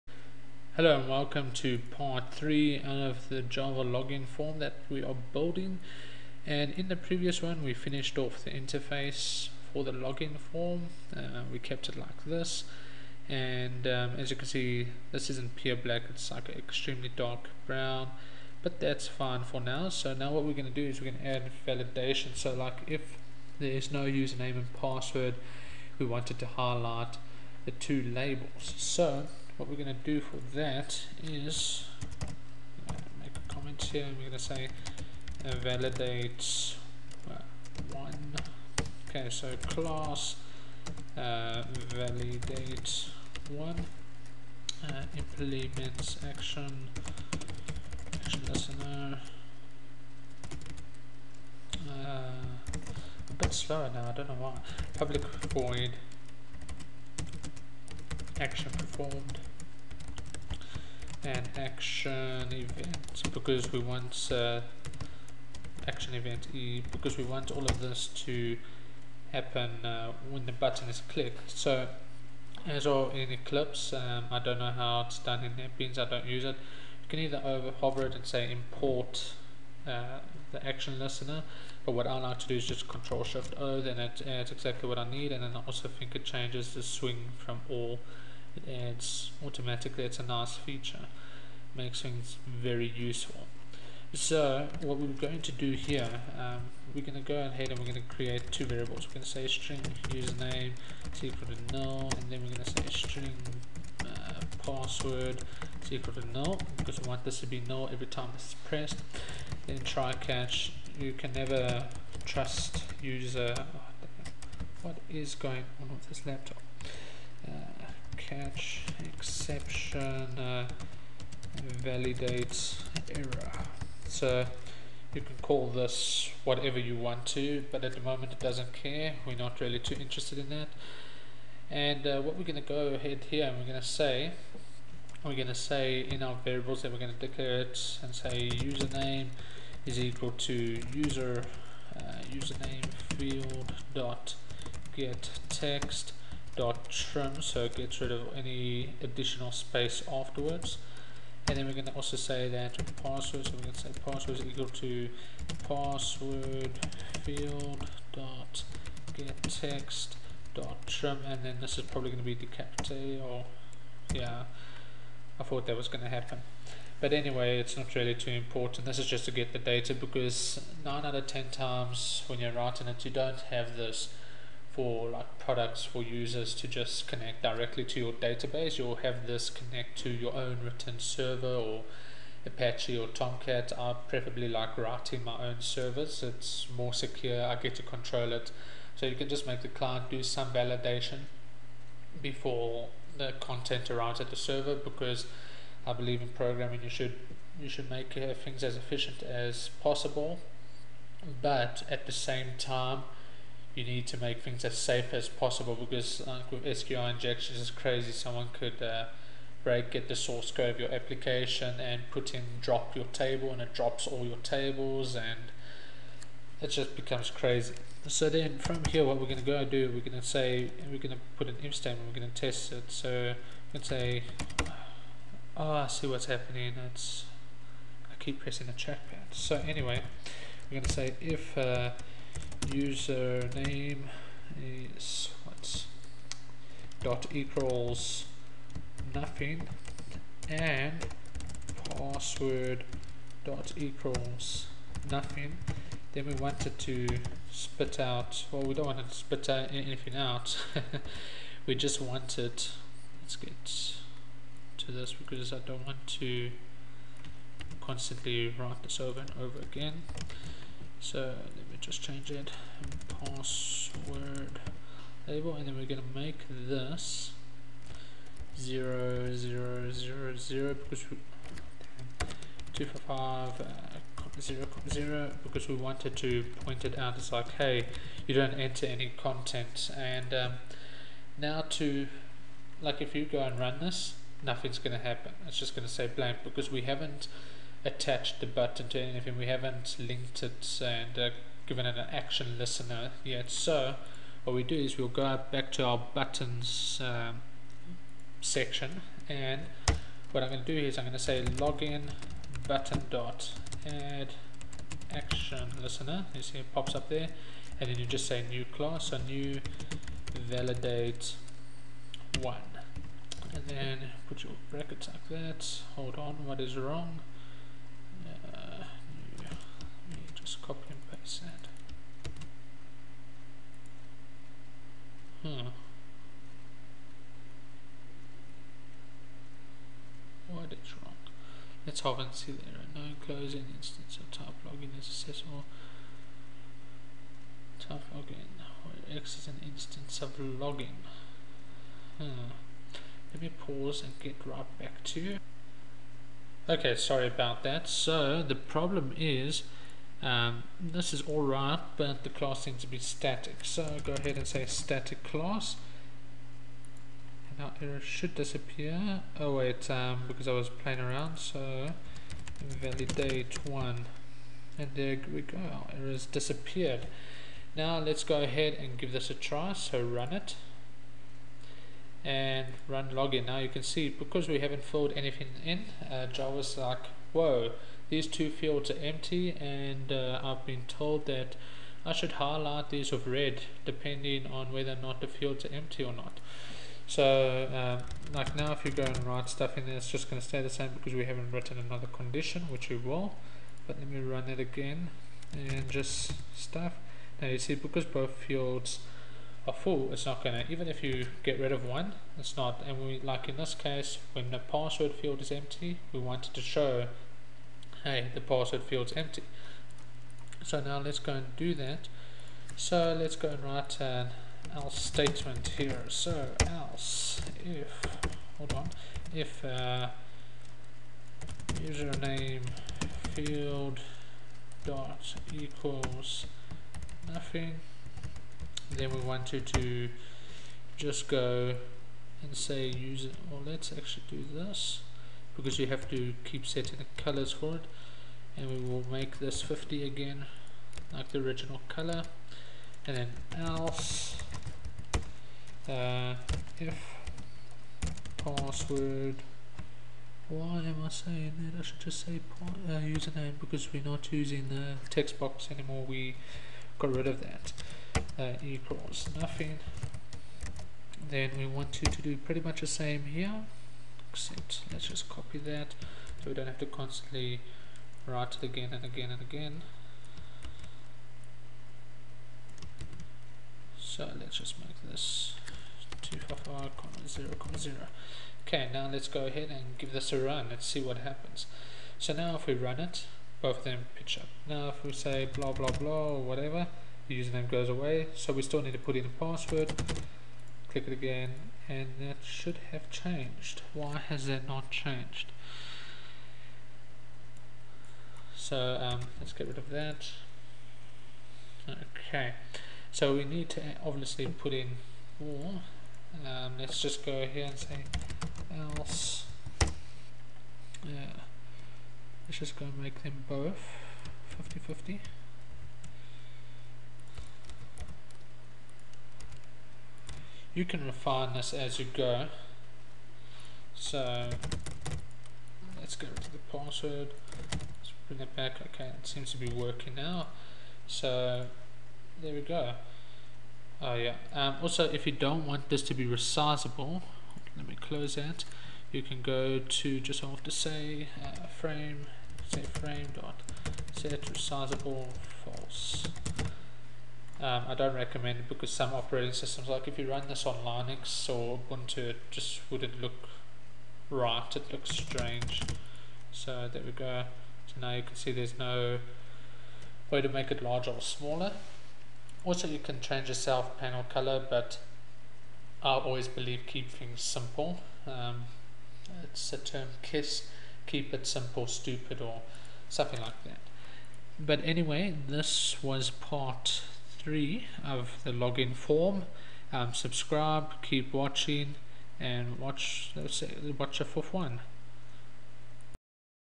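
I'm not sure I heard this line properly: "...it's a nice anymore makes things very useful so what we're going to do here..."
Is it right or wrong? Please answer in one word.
wrong.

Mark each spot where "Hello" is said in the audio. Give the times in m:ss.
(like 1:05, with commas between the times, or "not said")
0:00.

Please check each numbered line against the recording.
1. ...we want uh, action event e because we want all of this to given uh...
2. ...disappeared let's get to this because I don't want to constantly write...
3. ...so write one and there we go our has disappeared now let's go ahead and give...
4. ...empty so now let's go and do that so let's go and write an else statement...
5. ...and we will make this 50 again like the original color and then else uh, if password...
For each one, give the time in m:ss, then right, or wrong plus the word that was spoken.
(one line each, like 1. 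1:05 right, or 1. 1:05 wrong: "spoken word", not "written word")
1. 1:03 wrong: "happen", not "given"
2. 4:12 wrong: "wanted", not "disappeared"
3. 6:01 wrong: "validate", not "write"
4. 6:49 right
5. 7:18 right.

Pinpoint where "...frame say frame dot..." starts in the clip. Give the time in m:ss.
9:01.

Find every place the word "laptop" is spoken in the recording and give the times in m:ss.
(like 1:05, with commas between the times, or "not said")
1:56.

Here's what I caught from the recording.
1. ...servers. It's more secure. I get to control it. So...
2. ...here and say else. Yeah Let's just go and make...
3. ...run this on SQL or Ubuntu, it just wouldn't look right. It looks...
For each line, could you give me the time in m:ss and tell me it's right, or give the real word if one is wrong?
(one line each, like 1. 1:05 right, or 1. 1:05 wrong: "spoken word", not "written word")
1. 3:05 right
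2. 8:27 right
3. 9:10 wrong: "Linux", not "SQL".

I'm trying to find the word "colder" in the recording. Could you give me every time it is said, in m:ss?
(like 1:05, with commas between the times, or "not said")
not said.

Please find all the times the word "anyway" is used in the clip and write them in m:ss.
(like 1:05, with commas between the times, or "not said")
2:47, 3:49, 9:34.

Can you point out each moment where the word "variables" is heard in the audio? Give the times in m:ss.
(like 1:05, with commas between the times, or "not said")
1:38, 2:16.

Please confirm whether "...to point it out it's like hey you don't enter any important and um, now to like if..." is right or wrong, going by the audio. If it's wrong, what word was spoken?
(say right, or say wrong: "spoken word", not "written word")
wrong: "content", not "important".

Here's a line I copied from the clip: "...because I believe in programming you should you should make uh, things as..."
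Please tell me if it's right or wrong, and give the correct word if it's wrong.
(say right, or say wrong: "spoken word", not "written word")
right.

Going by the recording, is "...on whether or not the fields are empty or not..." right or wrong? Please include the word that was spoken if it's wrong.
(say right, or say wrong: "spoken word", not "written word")
right.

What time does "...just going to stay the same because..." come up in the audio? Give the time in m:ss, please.
6:30.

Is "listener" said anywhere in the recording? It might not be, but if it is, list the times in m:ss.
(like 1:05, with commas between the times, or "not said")
0:48, 1:20, 4:52, 5:05.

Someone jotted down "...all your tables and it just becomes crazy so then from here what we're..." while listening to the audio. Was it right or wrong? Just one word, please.
right.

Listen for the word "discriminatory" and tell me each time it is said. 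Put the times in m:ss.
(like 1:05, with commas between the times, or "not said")
not said.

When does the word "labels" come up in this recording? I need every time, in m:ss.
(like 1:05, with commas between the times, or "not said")
0:28, 4:25.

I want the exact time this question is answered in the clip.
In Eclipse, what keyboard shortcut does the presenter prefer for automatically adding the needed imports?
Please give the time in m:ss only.
1:22.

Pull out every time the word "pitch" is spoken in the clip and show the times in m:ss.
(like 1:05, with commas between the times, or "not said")
8:04.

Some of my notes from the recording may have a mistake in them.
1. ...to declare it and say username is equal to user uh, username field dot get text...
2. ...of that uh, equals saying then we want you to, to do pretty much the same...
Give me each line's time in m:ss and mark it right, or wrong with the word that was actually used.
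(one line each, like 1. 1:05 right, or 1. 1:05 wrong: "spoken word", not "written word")
1. 2:17 right
2. 7:37 wrong: "nothing", not "saying".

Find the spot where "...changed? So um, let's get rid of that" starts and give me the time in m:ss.
8:14.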